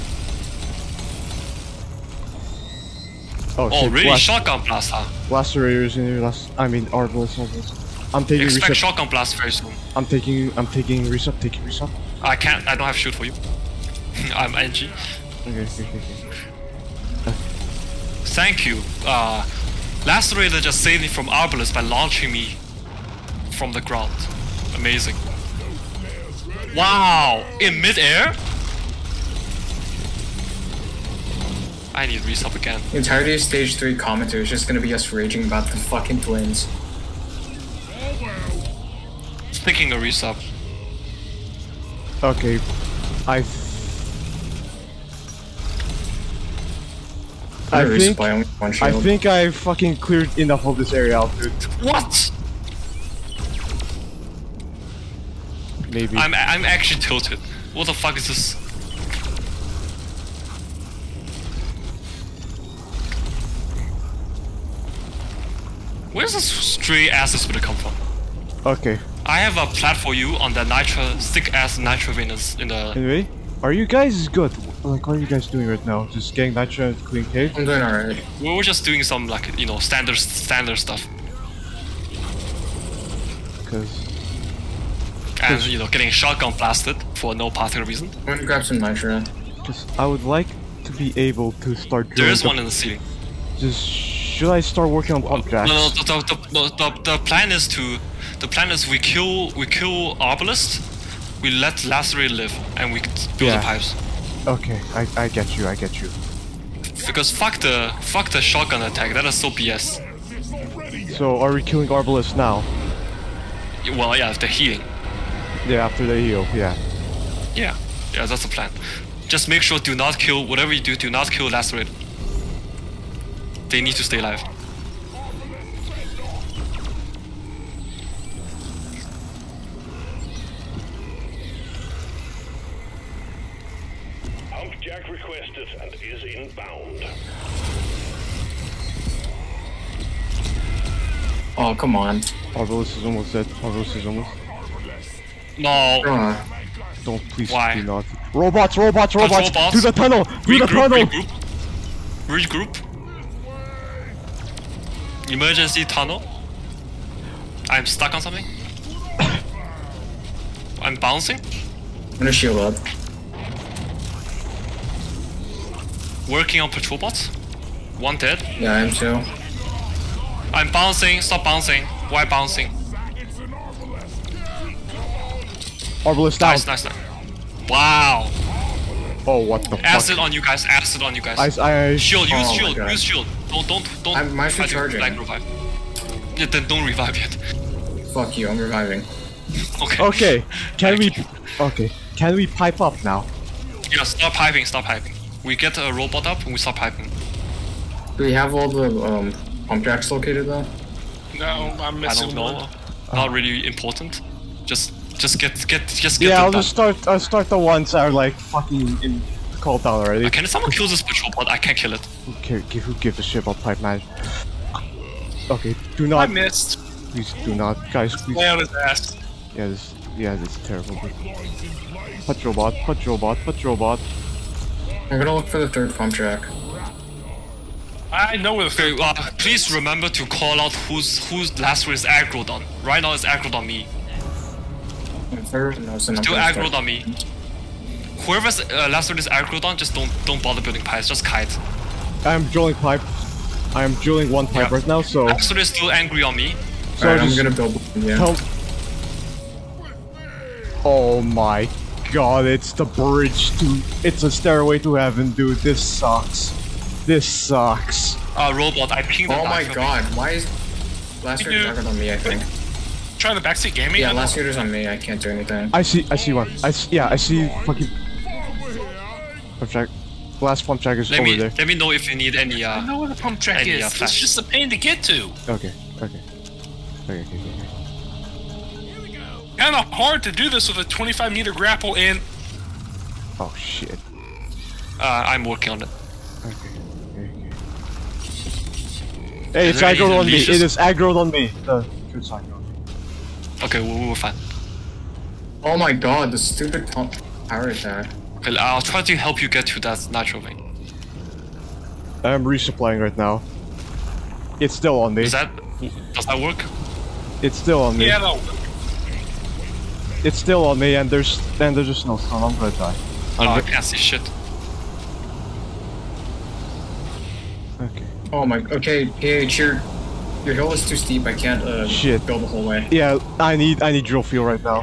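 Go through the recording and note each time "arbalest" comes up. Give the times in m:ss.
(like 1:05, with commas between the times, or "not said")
0:06, 0:21, 1:51, 2:56.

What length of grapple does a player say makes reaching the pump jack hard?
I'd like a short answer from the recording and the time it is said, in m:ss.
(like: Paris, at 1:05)
25 meters, at 4:40.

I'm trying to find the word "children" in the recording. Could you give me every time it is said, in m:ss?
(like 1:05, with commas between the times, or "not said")
not said.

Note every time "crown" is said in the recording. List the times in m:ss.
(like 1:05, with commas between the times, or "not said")
not said.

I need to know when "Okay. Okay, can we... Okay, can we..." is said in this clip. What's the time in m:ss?
3:09.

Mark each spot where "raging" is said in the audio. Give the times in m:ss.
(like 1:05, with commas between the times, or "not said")
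0:35.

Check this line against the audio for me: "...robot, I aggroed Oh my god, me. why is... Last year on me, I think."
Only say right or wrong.
wrong.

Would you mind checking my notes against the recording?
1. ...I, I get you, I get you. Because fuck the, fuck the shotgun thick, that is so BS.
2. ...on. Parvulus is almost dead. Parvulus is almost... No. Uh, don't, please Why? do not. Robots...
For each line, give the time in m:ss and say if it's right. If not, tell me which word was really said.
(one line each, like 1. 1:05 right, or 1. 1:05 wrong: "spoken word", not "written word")
1. 1:44 wrong: "attack", not "thick"
2. 2:21 right.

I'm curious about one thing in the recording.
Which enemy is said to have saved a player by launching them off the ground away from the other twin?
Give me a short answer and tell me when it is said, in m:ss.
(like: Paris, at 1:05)
Lacerator, at 0:20.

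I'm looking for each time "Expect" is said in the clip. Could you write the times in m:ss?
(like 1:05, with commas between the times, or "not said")
0:08.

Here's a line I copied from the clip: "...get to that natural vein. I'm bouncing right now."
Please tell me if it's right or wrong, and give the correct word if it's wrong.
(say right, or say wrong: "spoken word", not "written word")
wrong: "resupplying", not "bouncing".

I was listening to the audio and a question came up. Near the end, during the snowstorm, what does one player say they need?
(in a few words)
drill fuel.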